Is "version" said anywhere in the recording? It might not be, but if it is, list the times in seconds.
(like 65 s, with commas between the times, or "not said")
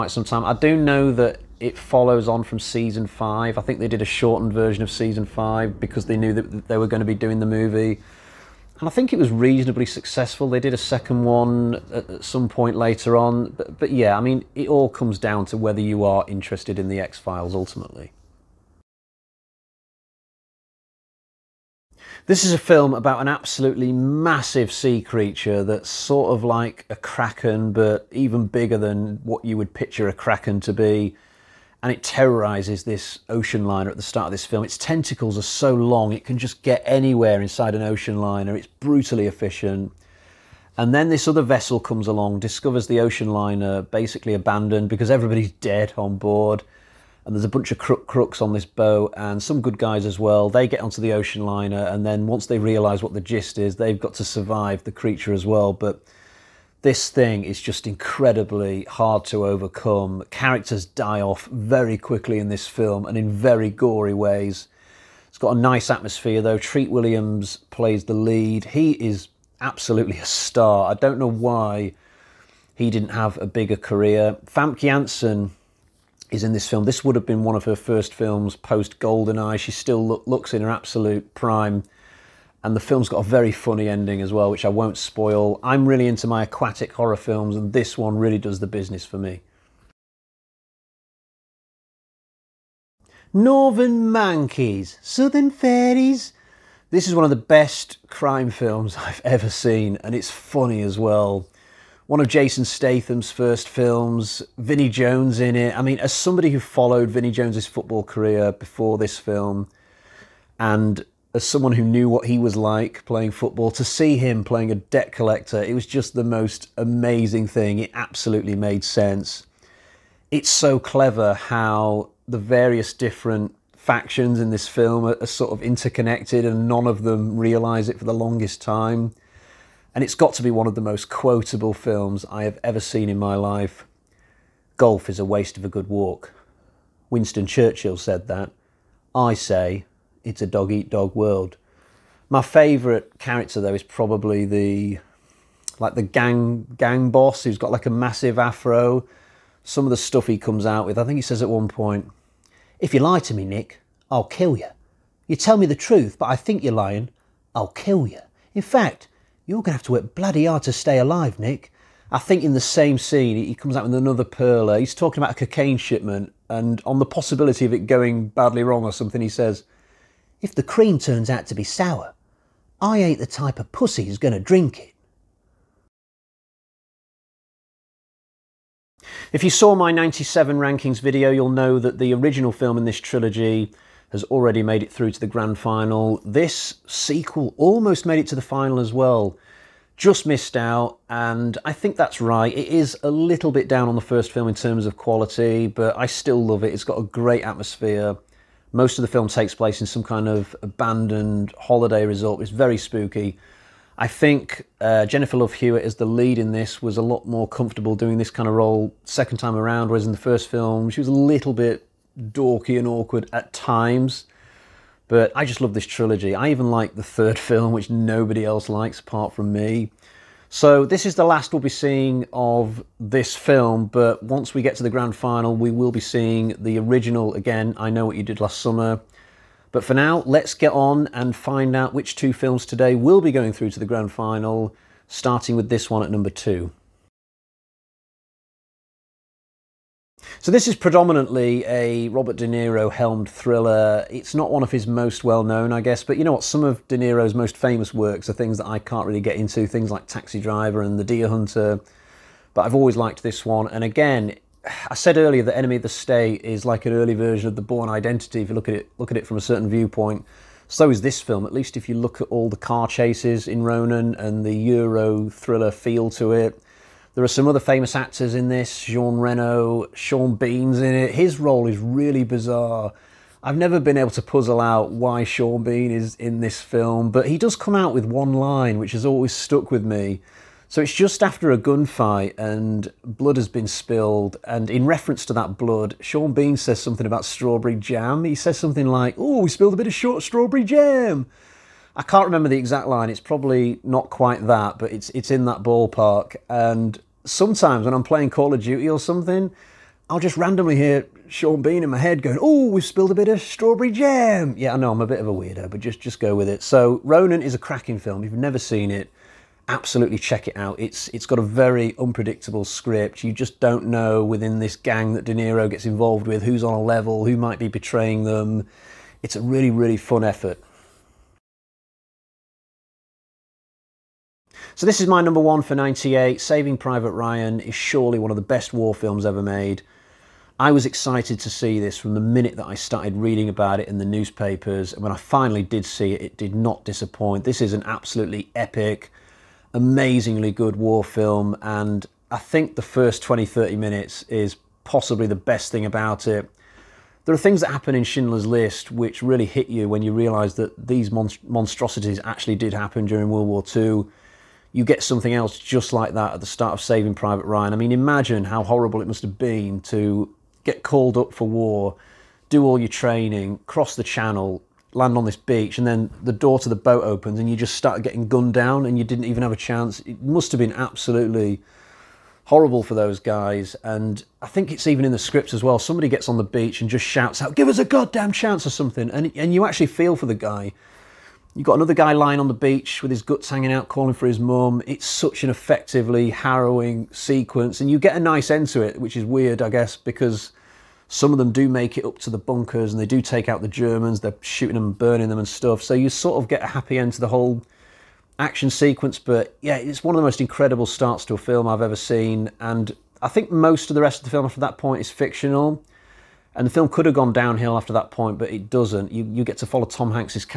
4 s, 257 s.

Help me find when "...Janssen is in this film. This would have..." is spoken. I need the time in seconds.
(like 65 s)
74 s.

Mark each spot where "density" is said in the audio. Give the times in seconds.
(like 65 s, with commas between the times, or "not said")
not said.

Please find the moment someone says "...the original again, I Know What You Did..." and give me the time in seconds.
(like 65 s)
226 s.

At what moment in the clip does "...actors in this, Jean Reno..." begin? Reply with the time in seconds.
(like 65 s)
267 s.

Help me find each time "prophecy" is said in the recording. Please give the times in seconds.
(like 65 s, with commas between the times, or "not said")
not said.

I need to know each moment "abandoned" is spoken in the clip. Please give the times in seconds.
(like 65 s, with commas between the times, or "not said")
44 s, 200 s.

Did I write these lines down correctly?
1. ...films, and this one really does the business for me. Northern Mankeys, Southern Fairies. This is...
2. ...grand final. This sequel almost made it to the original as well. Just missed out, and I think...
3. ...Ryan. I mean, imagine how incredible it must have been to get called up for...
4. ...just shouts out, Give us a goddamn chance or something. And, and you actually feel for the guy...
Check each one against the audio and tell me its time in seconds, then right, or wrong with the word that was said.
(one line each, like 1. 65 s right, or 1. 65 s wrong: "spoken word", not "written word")
1. 87 s right
2. 185 s wrong: "final", not "original"
3. 357 s wrong: "horrible", not "incredible"
4. 376 s right.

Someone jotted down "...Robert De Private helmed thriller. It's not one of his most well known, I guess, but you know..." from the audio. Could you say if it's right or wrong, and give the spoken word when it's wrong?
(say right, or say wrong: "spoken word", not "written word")
wrong: "Niro", not "Private".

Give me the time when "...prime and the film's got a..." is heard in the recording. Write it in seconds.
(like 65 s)
81 s.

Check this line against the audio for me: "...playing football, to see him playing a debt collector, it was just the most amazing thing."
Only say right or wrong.
right.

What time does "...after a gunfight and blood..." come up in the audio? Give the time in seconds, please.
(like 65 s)
281 s.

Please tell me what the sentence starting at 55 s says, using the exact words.
But this thing is just incredibly hard to overcome.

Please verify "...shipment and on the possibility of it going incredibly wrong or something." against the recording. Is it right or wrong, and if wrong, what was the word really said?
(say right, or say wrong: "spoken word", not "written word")
wrong: "badly", not "incredibly".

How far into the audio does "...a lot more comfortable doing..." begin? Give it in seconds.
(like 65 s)
206 s.